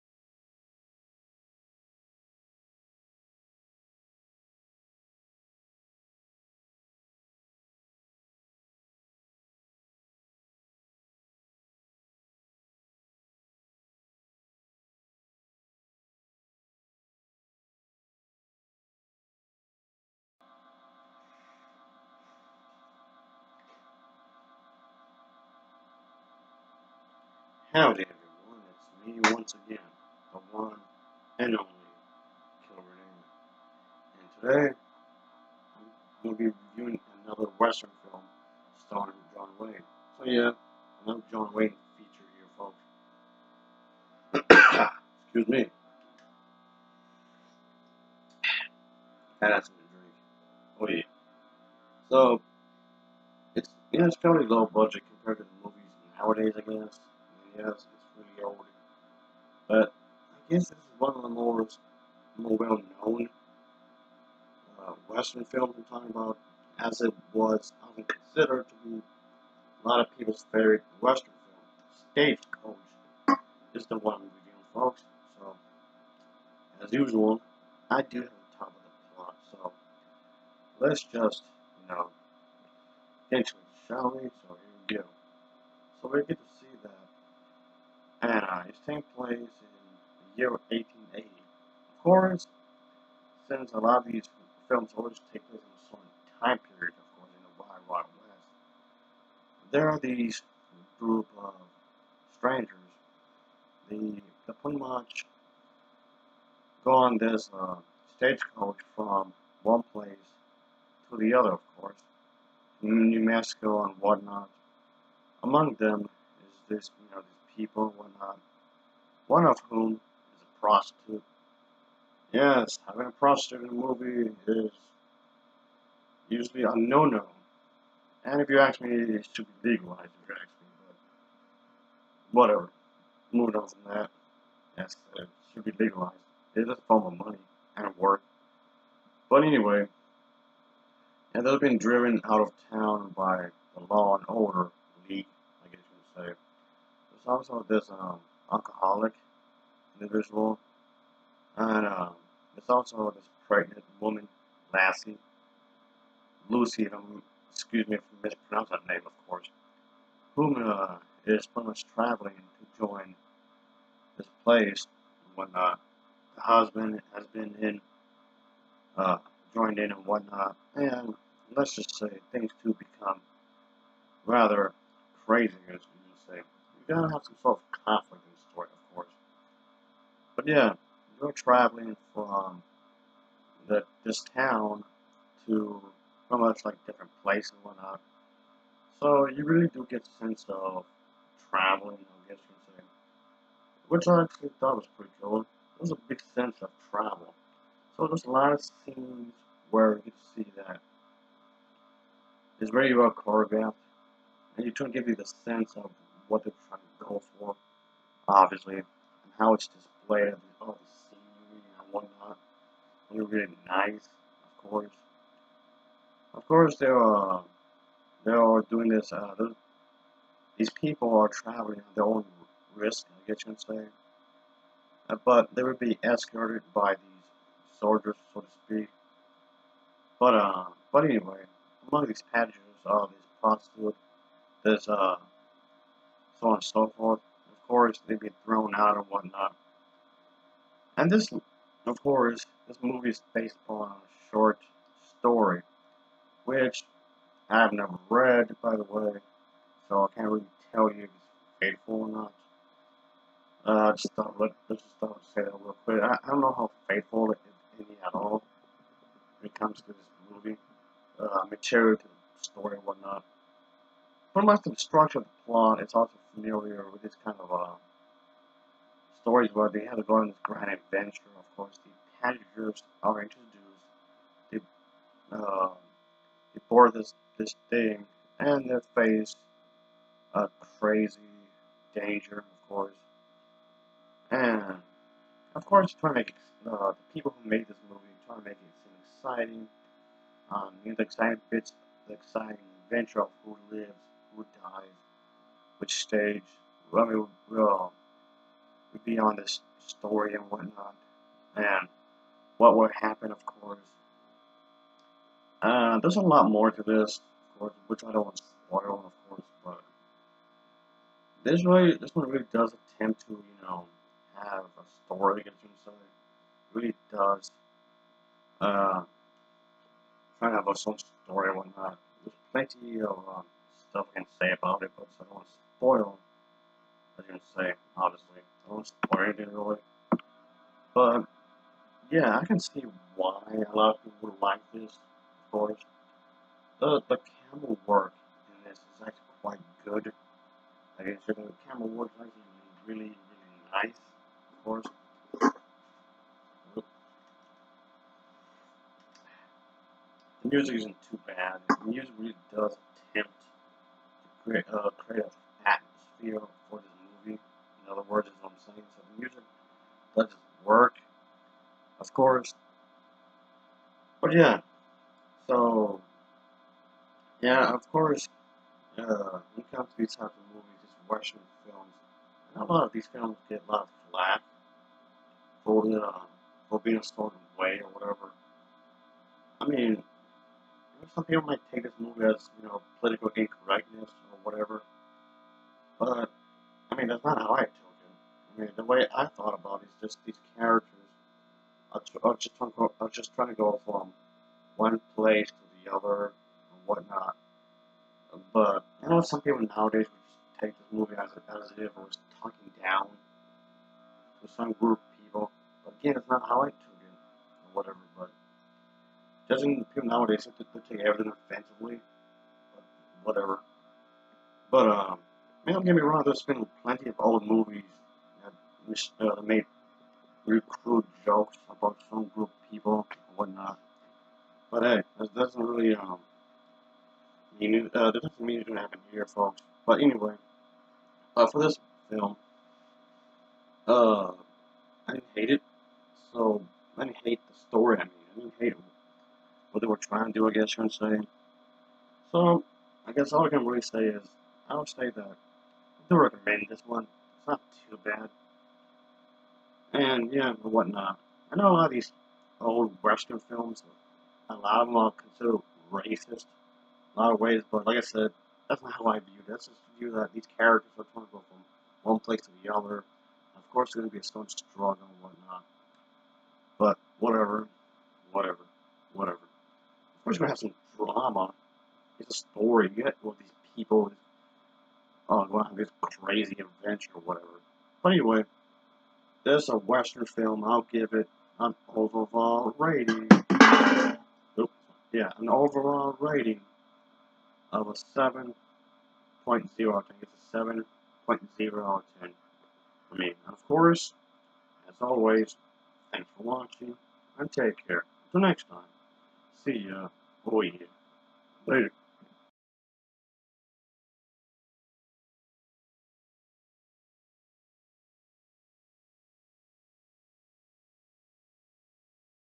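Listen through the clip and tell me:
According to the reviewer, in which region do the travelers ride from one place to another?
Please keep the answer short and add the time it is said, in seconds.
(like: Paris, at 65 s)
New Mexico, at 112 s.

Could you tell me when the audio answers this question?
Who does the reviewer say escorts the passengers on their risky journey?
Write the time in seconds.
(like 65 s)
227 s.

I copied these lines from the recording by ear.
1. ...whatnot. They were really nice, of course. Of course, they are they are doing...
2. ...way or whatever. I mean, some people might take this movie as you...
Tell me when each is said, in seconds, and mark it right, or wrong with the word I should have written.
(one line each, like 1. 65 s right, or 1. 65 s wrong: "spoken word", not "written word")
1. 211 s right
2. 377 s right.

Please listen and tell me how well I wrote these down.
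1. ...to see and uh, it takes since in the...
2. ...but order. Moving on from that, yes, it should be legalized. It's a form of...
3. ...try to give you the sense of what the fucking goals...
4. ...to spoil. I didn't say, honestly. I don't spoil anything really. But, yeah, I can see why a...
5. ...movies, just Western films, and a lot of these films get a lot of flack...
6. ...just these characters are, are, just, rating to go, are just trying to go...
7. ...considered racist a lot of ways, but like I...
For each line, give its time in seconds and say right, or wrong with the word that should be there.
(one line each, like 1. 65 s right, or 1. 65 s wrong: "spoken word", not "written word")
1. 86 s wrong: "place", not "since"
2. 132 s wrong: "whatever", not "order"
3. 204 s right
4. 325 s right
5. 370 s right
6. 390 s wrong: "trying", not "rating"
7. 455 s right.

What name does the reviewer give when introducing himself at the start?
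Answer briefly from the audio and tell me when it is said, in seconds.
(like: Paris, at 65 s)
Kilburn, at 32 s.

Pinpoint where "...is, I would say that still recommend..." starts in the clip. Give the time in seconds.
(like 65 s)
444 s.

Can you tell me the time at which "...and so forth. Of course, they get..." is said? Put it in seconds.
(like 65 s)
236 s.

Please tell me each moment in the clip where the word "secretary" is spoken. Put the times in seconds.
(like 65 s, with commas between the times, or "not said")
not said.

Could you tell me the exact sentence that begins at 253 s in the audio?
Uh, just thought, let, let's just thought say that real quick.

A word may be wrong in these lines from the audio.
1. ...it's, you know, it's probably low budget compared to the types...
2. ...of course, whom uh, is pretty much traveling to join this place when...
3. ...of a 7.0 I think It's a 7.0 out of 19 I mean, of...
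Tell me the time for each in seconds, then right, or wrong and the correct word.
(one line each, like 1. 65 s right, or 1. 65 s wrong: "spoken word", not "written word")
1. 53 s wrong: "movies", not "types"
2. 159 s right
3. 487 s wrong: "10", not "19".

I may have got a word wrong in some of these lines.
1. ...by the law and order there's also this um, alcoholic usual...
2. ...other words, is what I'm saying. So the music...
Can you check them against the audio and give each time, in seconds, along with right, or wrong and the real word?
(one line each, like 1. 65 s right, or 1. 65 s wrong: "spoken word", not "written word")
1. 143 s wrong: "individual", not "usual"
2. 357 s right.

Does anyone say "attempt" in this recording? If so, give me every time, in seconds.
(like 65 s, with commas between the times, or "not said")
312 s, 353 s.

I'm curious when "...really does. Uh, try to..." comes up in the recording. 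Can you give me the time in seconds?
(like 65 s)
316 s.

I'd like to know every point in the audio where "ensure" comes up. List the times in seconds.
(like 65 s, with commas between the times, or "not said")
not said.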